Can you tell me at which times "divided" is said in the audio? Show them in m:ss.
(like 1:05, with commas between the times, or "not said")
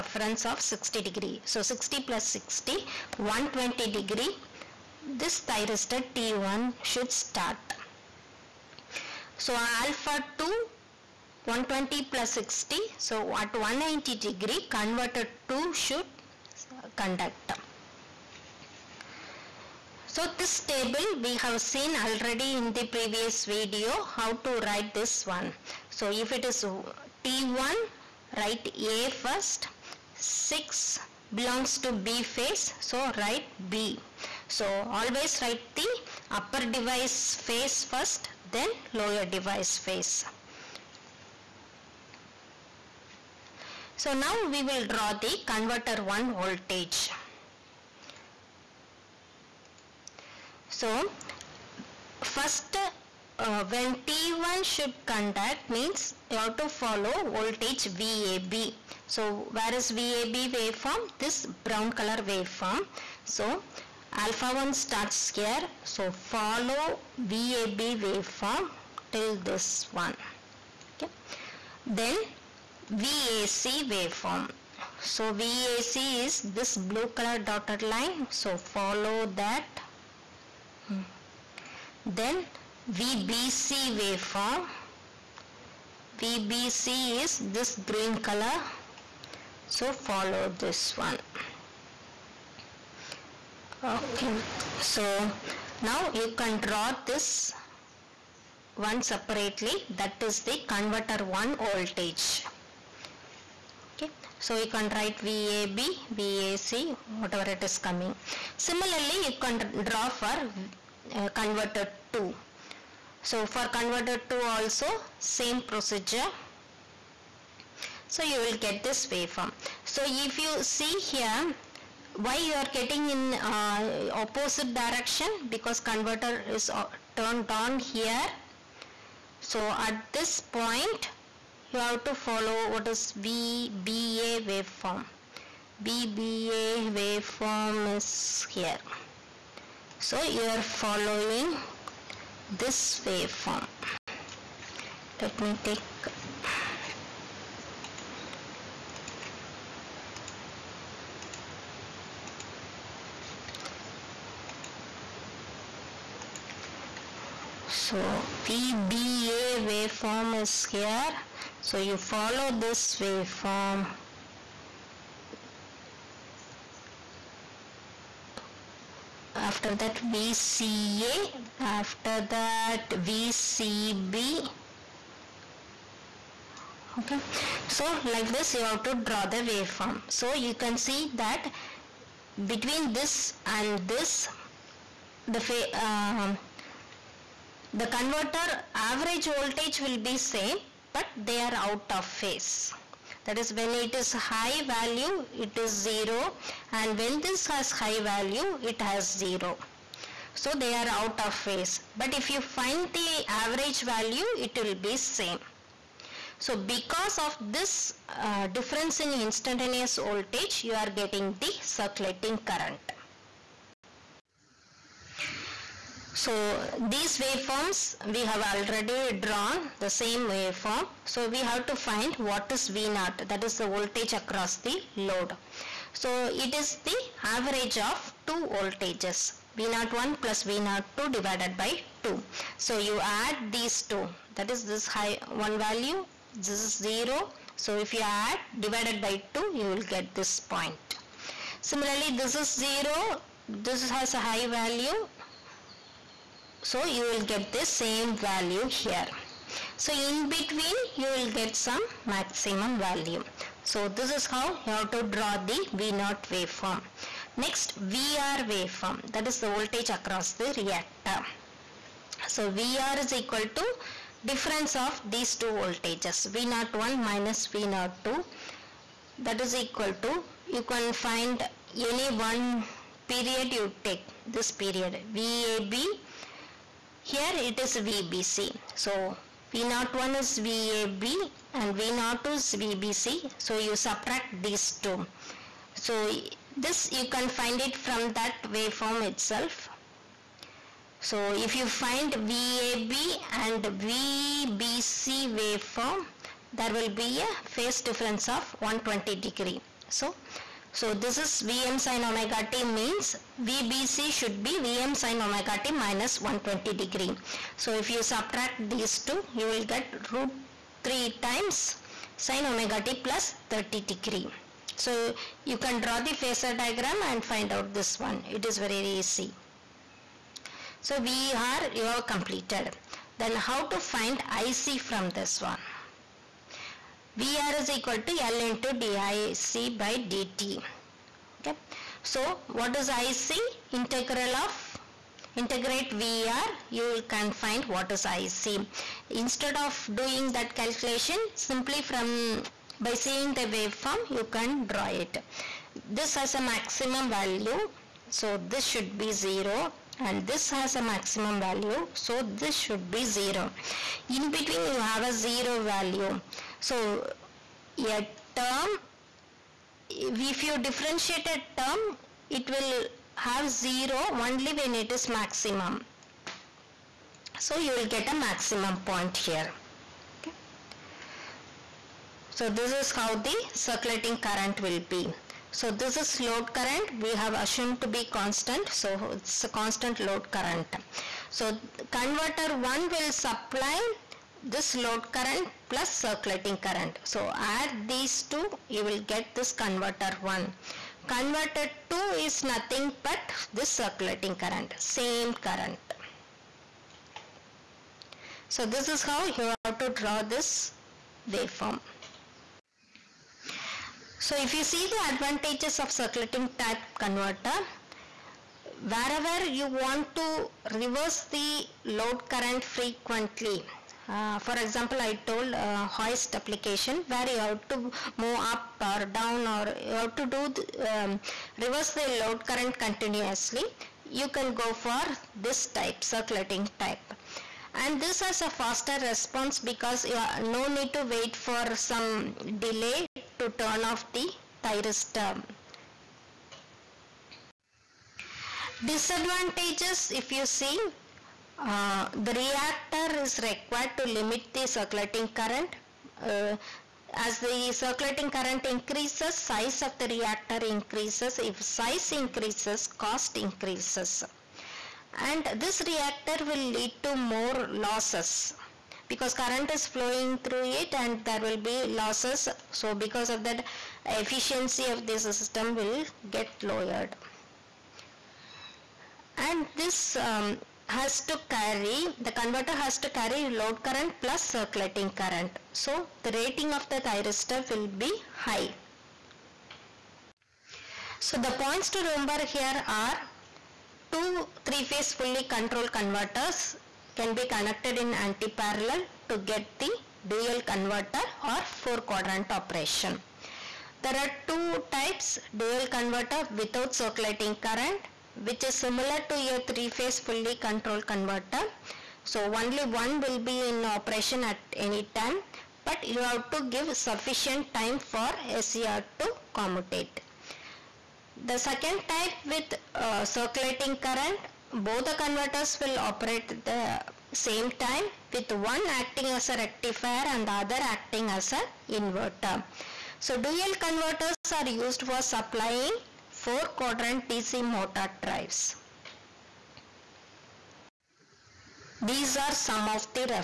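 3:51, 3:58.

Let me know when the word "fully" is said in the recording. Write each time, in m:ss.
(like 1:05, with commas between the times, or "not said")
8:05, 8:20.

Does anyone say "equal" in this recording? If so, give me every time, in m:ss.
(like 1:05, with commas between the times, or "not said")
4:23, 4:29, 5:27.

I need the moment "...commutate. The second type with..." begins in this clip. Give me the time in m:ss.
8:29.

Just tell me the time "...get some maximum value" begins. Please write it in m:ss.
4:11.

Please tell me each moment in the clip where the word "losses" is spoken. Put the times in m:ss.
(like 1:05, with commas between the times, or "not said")
7:37, 7:41.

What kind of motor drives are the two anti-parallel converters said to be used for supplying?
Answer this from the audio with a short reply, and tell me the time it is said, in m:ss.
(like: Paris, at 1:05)
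4 quadrant DC motor drives, at 8:46.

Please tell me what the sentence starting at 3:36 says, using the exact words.
So these waveforms we have already drawn the same waveform.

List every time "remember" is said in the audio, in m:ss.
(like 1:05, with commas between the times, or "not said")
8:02.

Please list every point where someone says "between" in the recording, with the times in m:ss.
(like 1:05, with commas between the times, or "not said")
3:02, 4:10, 5:54.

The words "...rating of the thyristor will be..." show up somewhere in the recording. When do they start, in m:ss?
7:56.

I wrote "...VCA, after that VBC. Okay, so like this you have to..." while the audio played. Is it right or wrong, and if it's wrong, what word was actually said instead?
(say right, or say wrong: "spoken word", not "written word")
wrong: "VCB", not "VBC".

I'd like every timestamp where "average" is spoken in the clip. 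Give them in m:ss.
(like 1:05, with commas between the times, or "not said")
3:08, 3:23, 3:47.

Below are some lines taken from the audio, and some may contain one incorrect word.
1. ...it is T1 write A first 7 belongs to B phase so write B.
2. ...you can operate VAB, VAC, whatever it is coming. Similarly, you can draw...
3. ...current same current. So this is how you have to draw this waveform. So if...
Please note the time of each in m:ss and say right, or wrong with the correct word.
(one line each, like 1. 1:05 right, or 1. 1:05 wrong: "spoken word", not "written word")
1. 0:26 wrong: "6", not "7"
2. 1:44 wrong: "write", not "operate"
3. 6:34 right.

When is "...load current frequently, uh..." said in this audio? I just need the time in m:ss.
6:51.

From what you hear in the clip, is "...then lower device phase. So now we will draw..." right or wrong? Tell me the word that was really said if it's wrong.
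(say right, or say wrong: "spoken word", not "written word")
right.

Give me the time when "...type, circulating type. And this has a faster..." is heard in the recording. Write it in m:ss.
7:05.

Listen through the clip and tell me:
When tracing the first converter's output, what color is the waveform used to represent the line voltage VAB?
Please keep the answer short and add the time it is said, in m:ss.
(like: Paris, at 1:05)
Brown, at 1:01.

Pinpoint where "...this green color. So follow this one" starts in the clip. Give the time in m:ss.
1:27.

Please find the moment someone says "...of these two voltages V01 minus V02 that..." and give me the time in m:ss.
4:24.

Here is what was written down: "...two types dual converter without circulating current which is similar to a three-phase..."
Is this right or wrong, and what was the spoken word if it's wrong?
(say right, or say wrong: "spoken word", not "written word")
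right.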